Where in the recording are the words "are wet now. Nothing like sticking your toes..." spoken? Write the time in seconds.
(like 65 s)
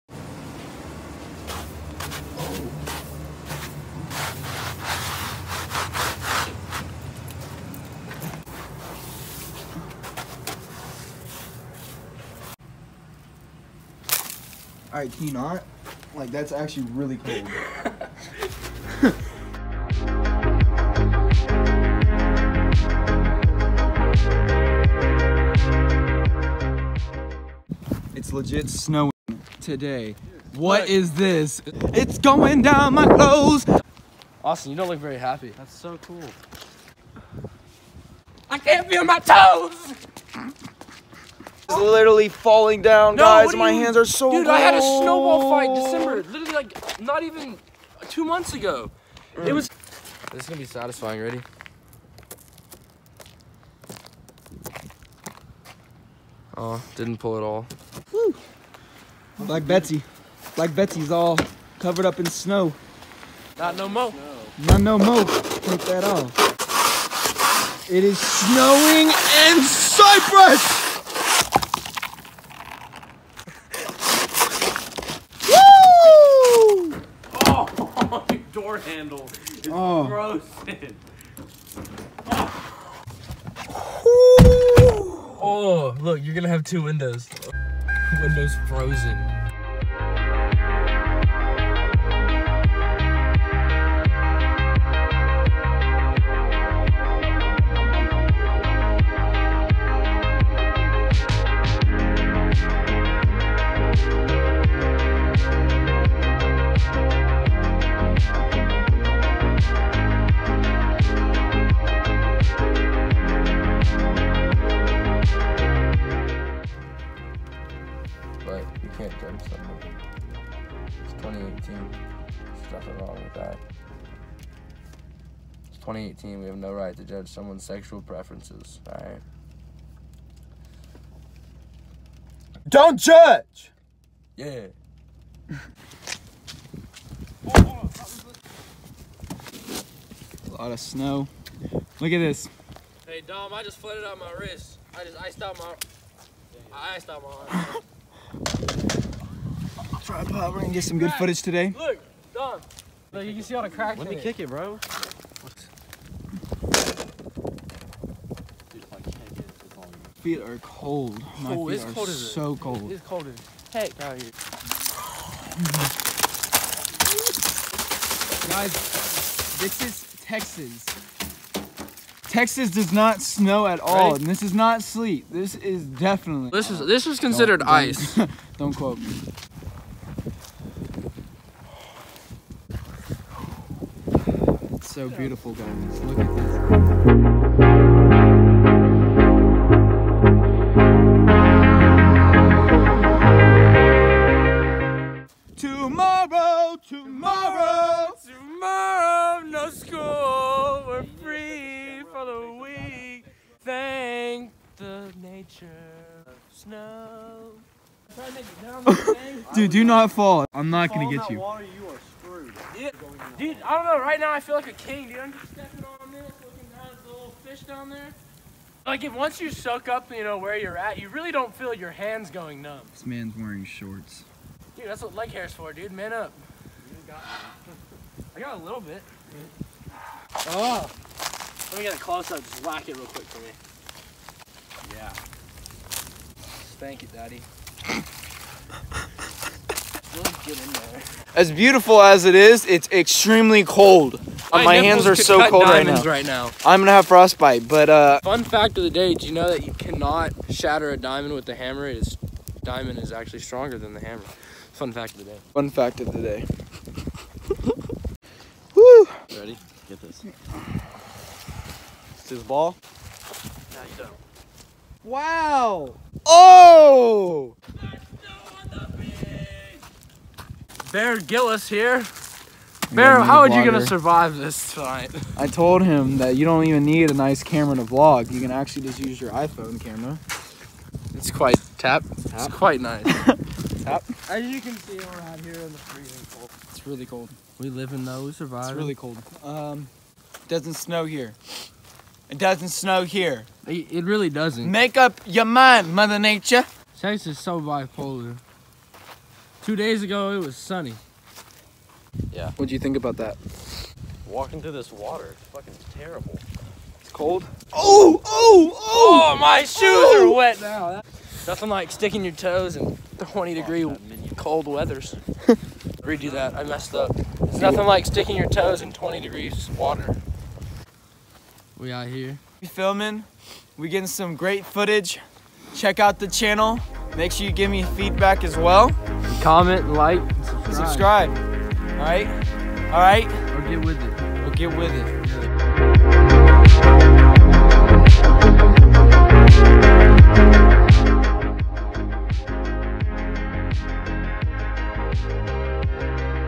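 310 s.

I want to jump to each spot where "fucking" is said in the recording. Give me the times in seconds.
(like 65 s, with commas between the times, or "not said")
305 s.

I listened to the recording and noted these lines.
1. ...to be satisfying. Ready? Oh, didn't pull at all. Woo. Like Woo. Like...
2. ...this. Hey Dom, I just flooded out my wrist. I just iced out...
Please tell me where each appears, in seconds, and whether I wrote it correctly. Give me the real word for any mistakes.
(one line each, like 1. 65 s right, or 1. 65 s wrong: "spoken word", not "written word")
1. 50 s wrong: "Betsy", not "Woo"
2. 142 s right.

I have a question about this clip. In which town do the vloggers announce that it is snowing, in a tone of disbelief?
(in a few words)
Cypress.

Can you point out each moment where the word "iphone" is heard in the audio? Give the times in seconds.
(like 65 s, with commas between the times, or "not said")
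279 s.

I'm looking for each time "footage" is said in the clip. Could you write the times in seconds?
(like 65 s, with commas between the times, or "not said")
151 s, 324 s.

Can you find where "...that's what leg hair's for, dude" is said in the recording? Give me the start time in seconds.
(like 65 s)
224 s.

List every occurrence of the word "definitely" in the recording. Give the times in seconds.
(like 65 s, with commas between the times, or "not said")
175 s.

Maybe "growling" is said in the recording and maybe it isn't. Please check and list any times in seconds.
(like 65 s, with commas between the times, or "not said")
not said.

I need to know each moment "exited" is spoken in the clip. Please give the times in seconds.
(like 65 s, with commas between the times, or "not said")
not said.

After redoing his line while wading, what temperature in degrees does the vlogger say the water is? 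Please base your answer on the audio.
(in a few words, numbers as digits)
20 degrees.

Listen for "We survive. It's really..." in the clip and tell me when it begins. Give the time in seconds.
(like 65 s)
288 s.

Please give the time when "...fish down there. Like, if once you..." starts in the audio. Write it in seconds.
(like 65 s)
217 s.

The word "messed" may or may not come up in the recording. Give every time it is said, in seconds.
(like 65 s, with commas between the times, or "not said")
316 s.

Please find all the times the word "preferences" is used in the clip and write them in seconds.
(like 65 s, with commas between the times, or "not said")
128 s.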